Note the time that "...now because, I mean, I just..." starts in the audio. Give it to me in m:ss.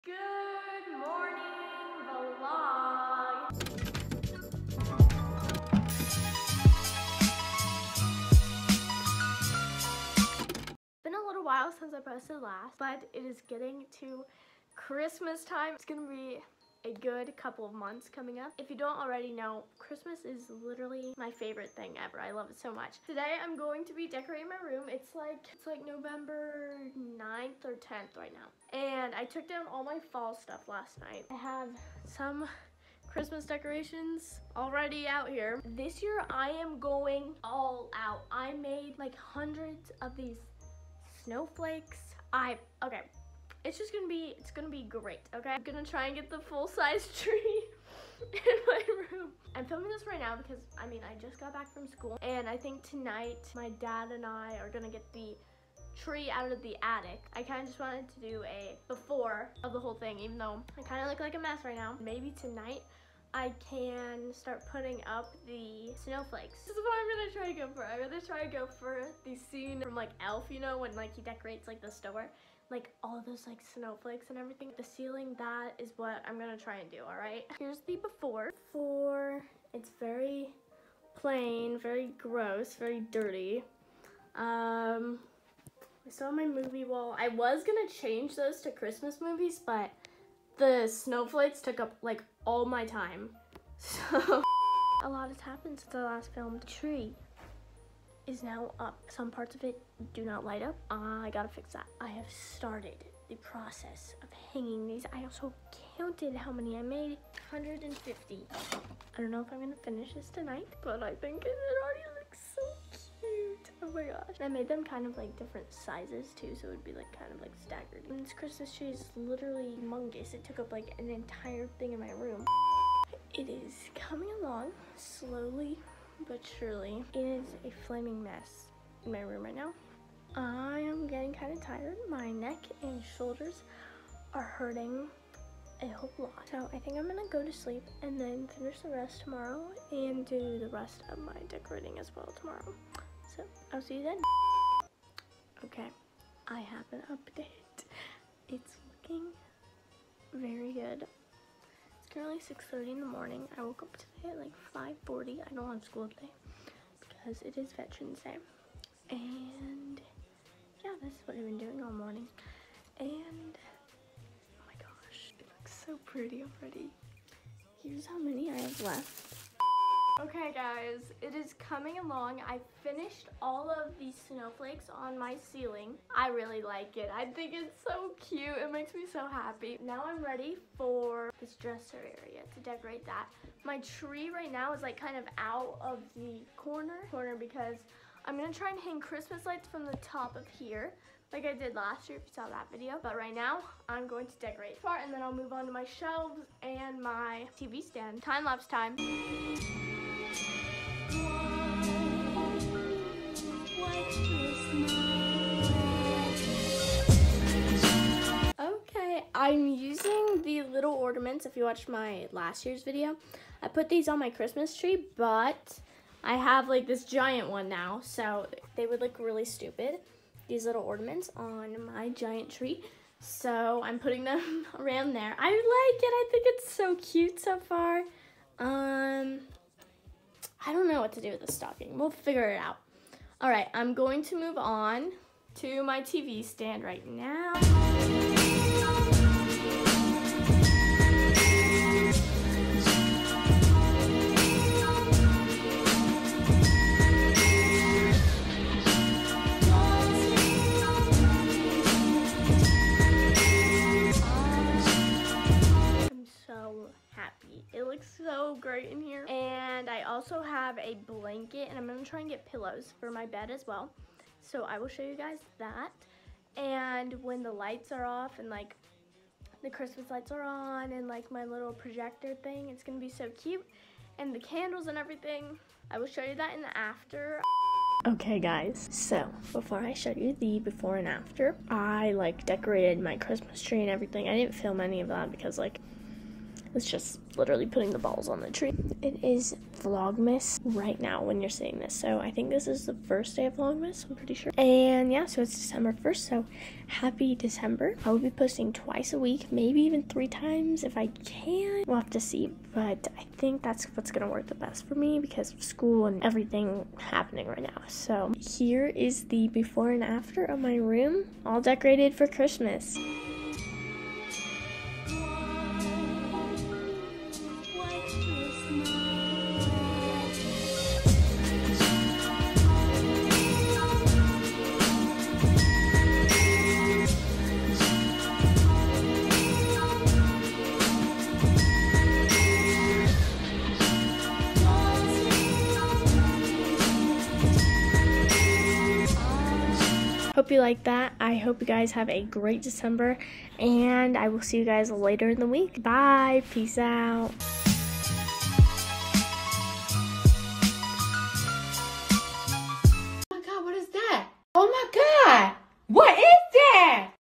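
0:50.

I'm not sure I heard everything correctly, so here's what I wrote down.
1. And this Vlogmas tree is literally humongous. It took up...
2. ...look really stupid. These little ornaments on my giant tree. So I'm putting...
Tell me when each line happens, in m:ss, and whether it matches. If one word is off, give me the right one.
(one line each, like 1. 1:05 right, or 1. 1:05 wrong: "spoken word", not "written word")
1. 1:58 wrong: "Christmas", not "Vlogmas"
2. 3:39 right.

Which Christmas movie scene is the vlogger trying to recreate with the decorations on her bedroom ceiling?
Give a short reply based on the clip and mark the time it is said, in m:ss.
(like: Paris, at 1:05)
Elf, at 1:10.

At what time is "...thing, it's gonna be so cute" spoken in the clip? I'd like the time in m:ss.
4:32.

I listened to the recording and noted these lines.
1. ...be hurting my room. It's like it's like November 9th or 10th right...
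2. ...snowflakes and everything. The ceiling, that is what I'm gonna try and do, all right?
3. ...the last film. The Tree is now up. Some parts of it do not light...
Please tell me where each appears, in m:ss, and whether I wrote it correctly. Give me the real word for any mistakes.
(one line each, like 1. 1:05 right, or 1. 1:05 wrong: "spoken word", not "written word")
1. 0:23 wrong: "decorating", not "hurting"
2. 1:13 right
3. 1:35 right.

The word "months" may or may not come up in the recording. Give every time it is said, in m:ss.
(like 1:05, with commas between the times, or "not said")
0:17.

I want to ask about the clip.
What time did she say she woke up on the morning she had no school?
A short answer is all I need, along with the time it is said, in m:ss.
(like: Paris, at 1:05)
5:40, at 2:35.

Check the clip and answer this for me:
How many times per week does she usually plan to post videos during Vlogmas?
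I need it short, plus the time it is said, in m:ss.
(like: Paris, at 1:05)
twice, at 4:58.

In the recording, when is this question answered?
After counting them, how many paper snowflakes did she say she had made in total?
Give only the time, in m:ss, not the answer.
1:47.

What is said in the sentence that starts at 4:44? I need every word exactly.
I didn't film any of that because like it's just literally putting the balls on the tree.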